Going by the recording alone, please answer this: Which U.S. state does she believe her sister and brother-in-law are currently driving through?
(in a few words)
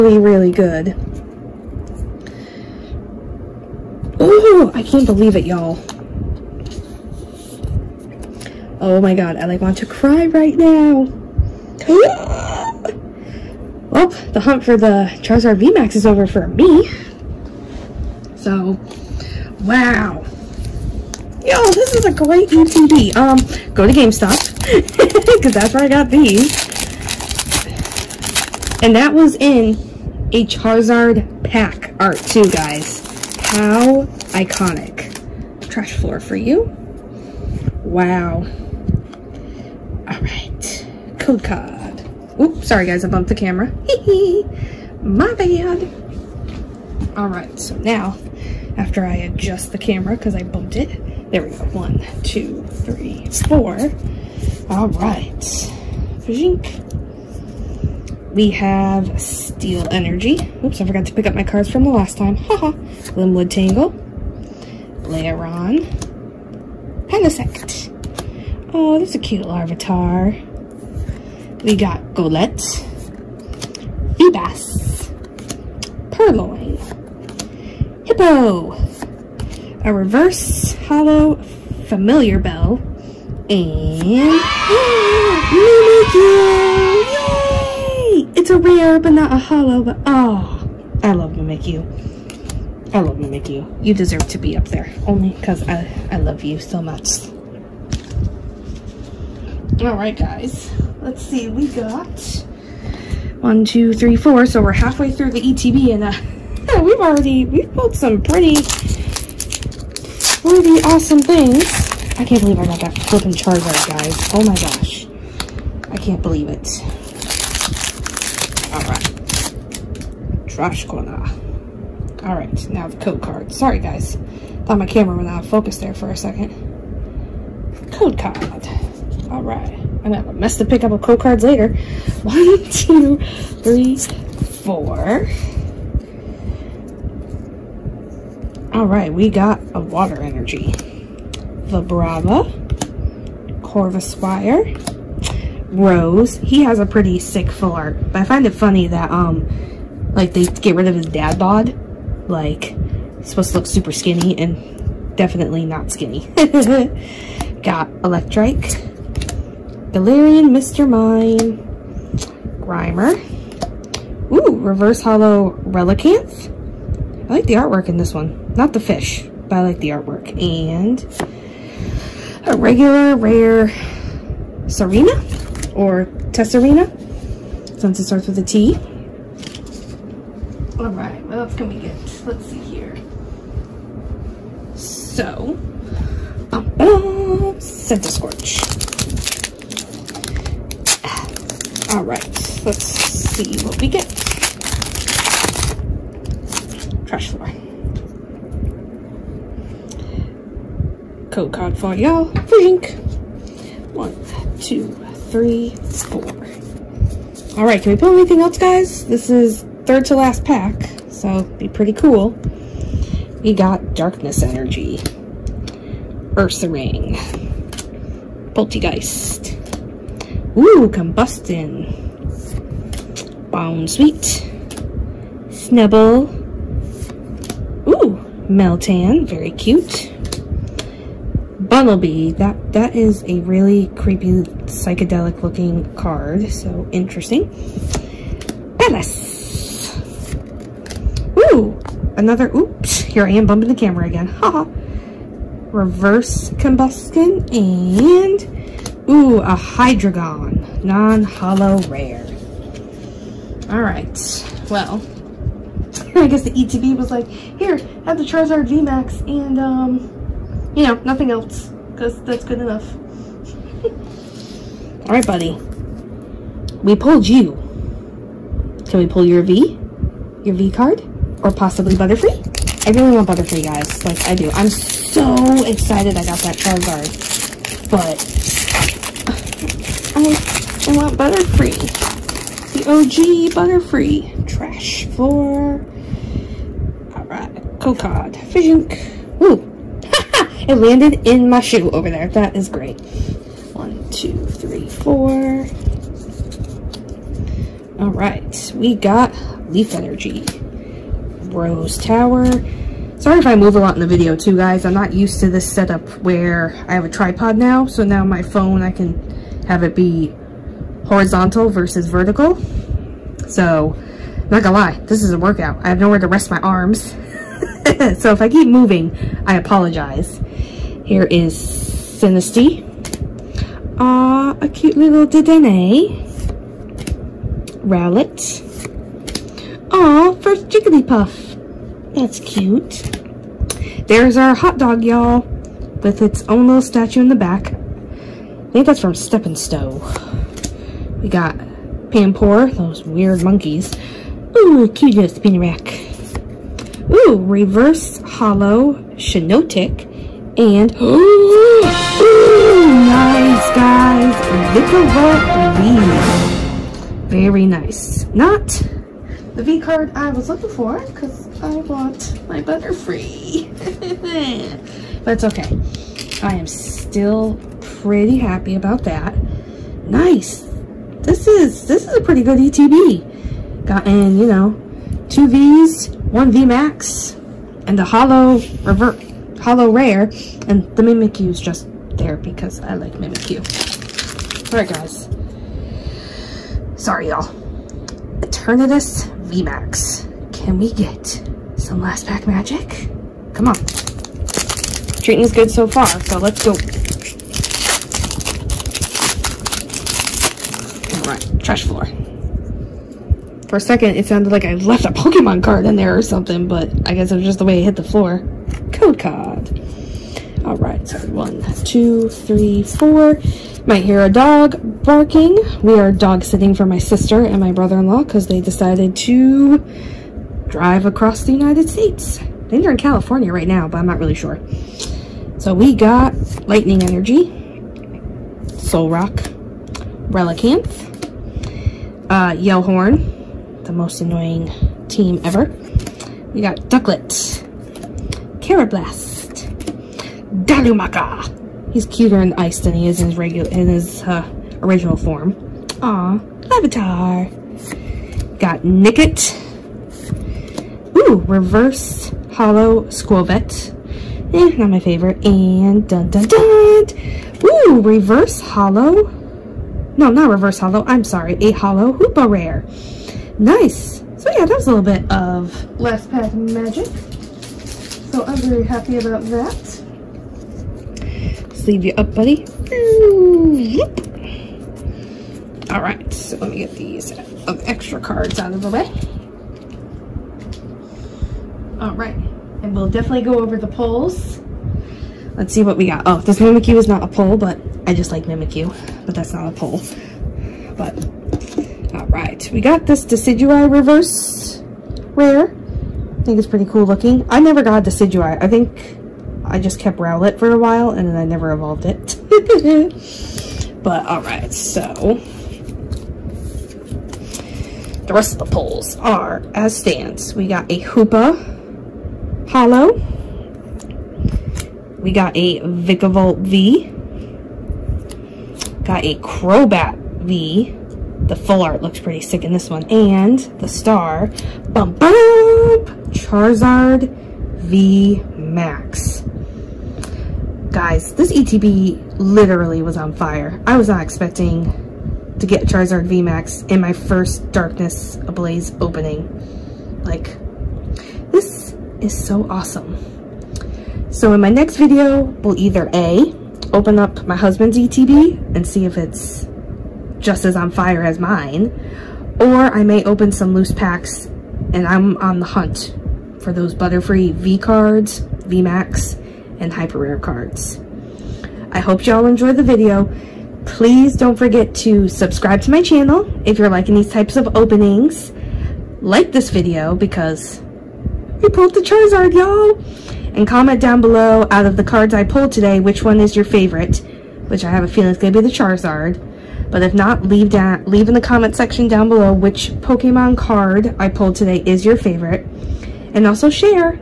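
California.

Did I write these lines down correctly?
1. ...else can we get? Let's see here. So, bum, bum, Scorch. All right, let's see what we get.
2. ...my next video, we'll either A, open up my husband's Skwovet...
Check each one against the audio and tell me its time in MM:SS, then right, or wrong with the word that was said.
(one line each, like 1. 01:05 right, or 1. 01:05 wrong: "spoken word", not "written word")
1. 03:01 right
2. 09:04 wrong: "ETB", not "Skwovet".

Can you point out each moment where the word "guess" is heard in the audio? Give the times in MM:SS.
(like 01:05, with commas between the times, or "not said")
04:16, 06:47.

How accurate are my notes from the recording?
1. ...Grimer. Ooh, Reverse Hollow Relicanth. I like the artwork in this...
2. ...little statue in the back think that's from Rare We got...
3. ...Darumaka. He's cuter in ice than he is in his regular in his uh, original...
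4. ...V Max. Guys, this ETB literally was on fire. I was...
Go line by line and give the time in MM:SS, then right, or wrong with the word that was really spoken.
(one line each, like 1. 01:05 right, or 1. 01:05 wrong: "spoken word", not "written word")
1. 02:42 right
2. 05:36 wrong: "Step", not "Rare"
3. 07:20 right
4. 08:47 right.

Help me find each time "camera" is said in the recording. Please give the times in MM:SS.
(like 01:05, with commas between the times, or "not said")
00:43, 00:49, 02:04, 04:03.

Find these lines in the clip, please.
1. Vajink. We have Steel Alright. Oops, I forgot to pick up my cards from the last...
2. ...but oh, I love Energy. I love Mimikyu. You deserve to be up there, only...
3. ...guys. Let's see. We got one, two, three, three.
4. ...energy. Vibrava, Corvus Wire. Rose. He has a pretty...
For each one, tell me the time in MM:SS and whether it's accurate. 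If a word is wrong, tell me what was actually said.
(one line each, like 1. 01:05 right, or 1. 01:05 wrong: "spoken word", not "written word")
1. 00:56 wrong: "Energy", not "Alright"
2. 01:29 wrong: "Mimikyu", not "Energy"
3. 01:40 wrong: "four", not "three"
4. 02:20 right.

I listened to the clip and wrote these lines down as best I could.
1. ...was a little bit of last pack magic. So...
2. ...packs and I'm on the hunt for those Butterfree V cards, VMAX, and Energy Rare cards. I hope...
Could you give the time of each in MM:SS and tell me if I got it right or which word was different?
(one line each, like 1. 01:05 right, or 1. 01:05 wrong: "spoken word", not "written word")
1. 07:44 right
2. 09:13 wrong: "Hyper", not "Energy".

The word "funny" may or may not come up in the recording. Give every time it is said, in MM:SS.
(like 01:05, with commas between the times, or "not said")
02:28.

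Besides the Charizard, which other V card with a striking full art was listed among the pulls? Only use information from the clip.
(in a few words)
Crobat V.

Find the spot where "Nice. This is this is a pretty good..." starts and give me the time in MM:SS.
06:10.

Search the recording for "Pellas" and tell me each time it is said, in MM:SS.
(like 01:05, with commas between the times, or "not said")
03:58.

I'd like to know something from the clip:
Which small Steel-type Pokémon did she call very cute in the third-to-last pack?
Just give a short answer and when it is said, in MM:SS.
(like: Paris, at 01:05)
Meltan, at 03:48.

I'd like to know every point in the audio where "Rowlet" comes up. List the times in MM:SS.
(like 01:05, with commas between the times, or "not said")
05:27, 08:20.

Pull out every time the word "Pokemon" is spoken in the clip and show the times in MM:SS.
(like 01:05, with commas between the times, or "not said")
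06:45, 09:42.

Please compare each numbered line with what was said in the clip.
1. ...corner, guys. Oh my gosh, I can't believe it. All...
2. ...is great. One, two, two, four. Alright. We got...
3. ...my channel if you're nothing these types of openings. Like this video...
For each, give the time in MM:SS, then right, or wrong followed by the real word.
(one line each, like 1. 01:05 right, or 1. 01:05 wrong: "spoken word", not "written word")
1. 01:53 wrong: "charger", not "corner"
2. 04:52 wrong: "three", not "two"
3. 09:25 wrong: "liking", not "nothing".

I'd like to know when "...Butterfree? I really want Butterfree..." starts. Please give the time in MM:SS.
04:31.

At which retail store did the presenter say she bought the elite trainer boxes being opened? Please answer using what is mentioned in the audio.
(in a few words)
GameStop.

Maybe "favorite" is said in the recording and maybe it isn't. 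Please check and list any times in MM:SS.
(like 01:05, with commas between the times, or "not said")
07:34, 09:36, 09:45.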